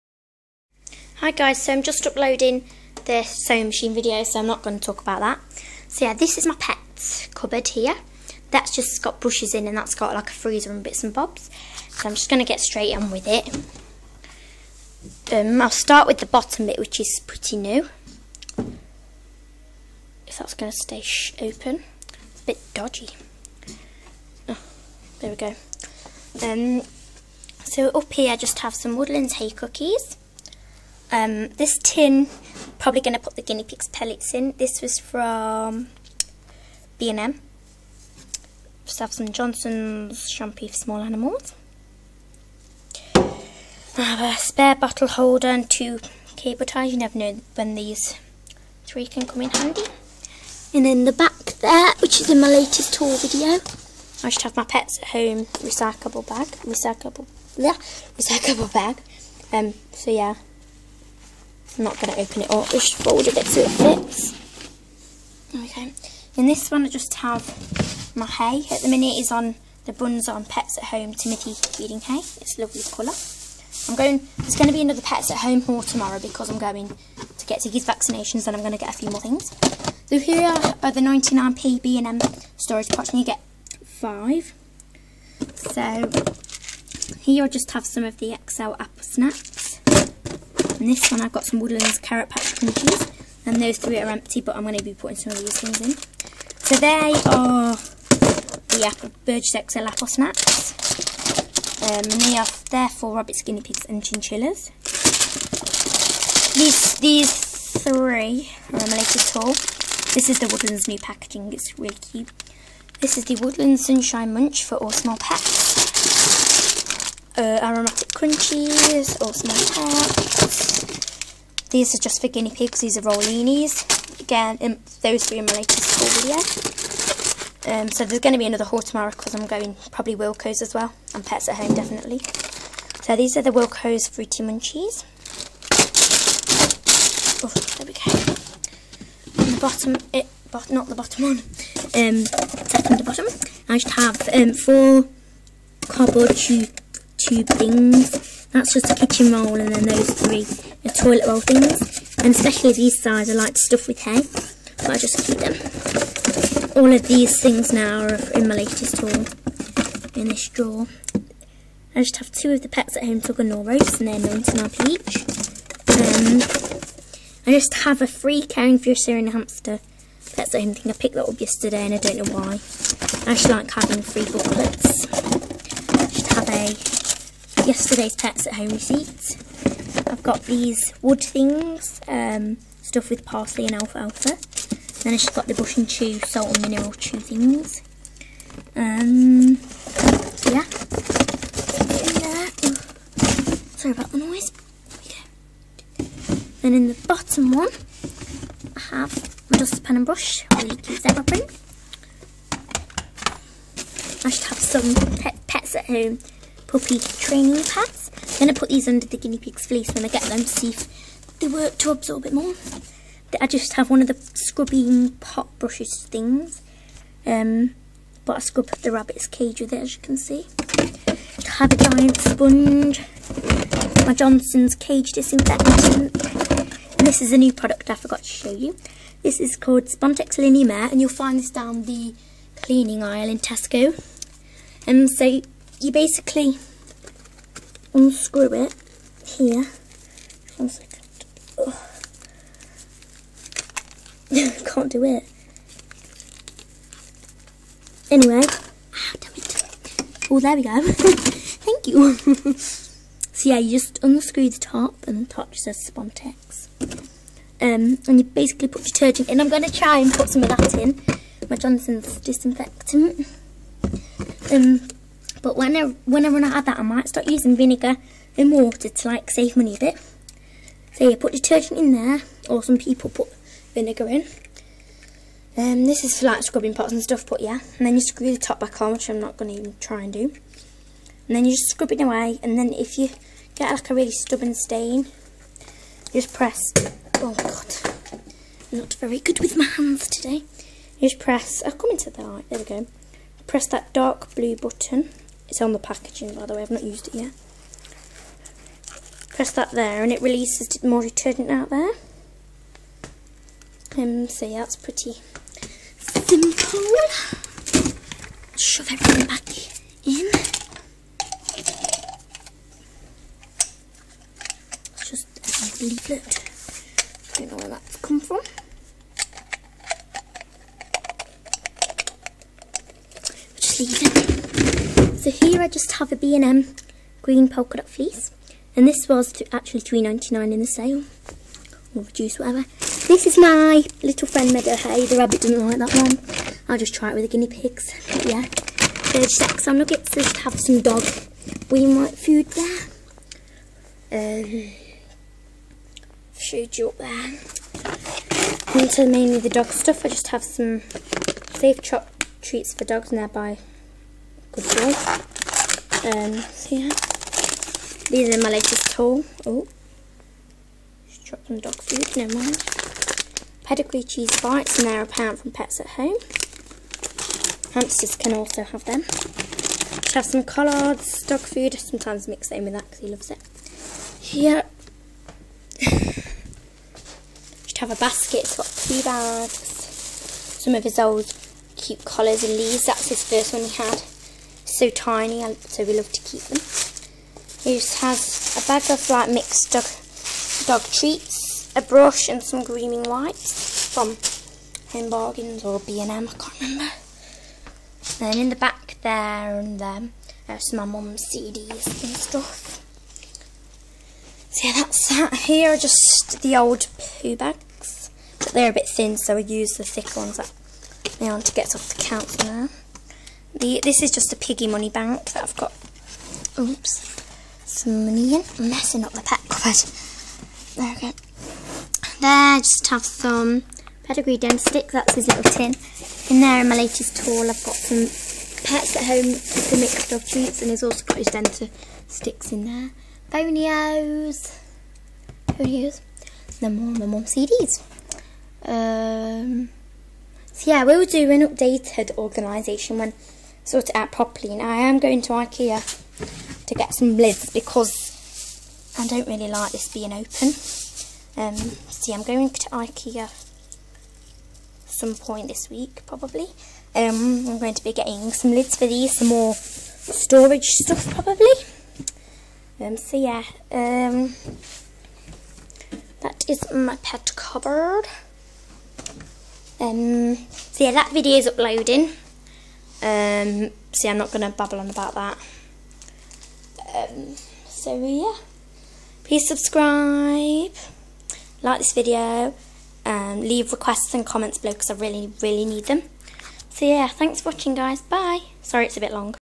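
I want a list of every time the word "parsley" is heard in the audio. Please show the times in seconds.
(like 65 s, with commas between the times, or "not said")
183 s.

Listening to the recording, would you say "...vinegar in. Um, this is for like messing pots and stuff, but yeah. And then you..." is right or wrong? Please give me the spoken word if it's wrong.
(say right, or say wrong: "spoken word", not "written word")
wrong: "scrubbing", not "messing".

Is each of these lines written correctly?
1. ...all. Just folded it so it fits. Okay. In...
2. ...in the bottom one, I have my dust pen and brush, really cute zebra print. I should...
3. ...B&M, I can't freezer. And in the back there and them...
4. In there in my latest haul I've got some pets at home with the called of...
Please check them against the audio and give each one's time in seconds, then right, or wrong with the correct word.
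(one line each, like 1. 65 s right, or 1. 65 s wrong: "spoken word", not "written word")
1. 62 s right
2. 196 s right
3. 395 s wrong: "remember", not "freezer"
4. 426 s wrong: "mixed", not "called".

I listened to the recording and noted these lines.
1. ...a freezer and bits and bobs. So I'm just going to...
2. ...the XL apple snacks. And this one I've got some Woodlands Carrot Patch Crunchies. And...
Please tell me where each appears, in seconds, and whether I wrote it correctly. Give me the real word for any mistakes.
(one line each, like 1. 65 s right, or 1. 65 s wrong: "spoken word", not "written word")
1. 10 s right
2. 88 s right.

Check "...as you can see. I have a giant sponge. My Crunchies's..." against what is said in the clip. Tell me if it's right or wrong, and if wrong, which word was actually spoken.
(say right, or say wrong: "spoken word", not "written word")
wrong: "Johnson", not "Crunchies".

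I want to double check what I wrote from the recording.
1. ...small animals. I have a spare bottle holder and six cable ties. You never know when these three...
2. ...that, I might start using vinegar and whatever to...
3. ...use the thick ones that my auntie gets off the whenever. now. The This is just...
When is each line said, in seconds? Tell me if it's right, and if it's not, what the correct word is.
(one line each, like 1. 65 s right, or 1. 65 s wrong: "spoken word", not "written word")
1. 40 s wrong: "two", not "six"
2. 266 s wrong: "water", not "whatever"
3. 409 s wrong: "counter", not "whenever".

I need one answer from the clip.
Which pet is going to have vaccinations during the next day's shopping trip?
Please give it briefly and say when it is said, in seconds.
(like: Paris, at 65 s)
Ziggy, at 77 s.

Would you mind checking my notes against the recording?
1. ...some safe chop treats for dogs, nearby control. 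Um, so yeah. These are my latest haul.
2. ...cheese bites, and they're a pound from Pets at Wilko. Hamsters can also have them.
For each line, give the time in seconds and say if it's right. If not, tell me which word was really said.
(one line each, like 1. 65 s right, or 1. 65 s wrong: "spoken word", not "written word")
1. 350 s right
2. 364 s wrong: "Home", not "Wilko".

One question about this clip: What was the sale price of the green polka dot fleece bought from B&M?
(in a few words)
£3.99.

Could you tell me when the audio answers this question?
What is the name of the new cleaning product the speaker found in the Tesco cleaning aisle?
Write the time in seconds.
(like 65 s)
229 s.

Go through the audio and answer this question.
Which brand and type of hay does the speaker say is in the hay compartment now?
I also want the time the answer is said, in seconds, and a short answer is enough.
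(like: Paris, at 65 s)
Pets at Home Timothy feeding hay, at 70 s.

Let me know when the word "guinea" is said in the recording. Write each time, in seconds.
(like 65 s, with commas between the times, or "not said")
33 s, 103 s, 122 s, 209 s, 337 s.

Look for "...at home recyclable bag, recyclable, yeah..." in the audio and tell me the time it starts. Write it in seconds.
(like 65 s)
55 s.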